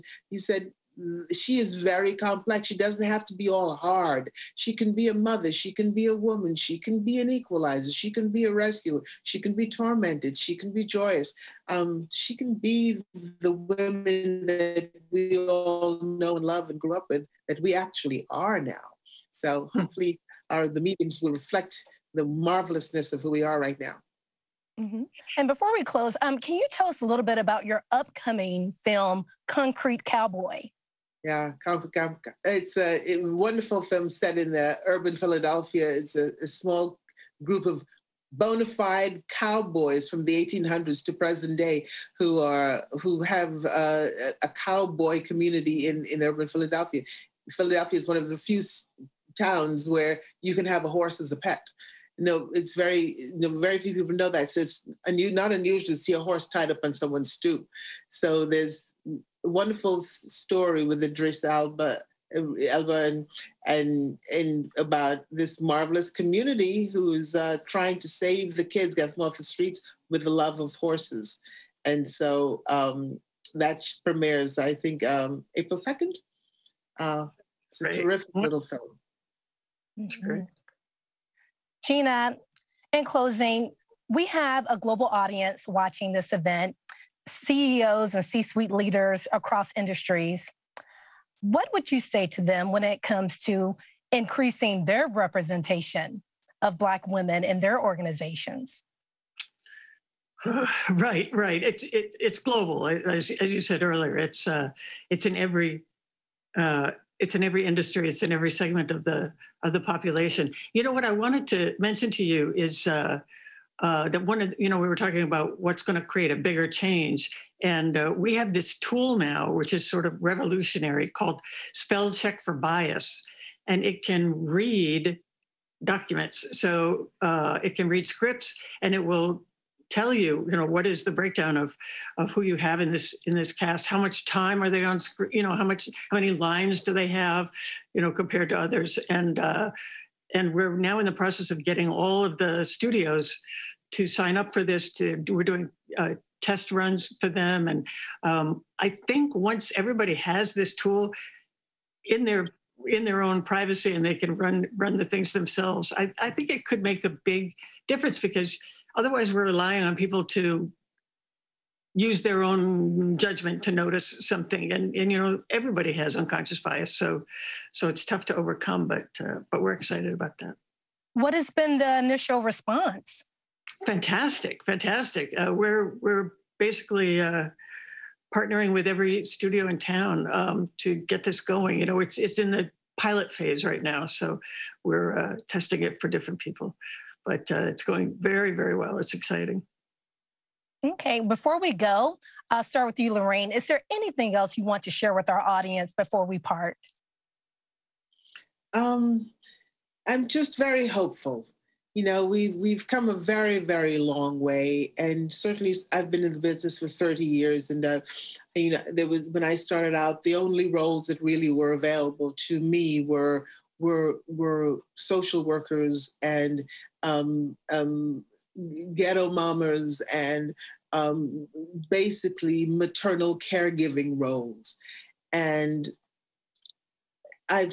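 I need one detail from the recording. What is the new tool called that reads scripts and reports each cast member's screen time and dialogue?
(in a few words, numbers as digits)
spell check for bias.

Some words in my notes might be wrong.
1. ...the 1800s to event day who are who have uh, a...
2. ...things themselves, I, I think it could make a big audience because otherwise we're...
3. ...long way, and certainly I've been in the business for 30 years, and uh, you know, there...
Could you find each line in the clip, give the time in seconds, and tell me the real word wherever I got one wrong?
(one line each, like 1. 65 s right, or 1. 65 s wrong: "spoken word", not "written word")
1. 40 s wrong: "present", not "event"
2. 155 s wrong: "difference", not "audience"
3. 203 s right.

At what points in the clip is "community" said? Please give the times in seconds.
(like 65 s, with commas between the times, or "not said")
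45 s, 66 s.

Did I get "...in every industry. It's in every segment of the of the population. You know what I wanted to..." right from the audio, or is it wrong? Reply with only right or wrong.
right.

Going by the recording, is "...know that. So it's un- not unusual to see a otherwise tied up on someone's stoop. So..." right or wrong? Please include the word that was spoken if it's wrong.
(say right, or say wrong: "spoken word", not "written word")
wrong: "horse", not "otherwise".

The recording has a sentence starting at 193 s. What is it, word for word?
Is there anything else you want to share with our audience before we part?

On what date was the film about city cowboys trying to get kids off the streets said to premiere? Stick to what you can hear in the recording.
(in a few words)
April 2nd.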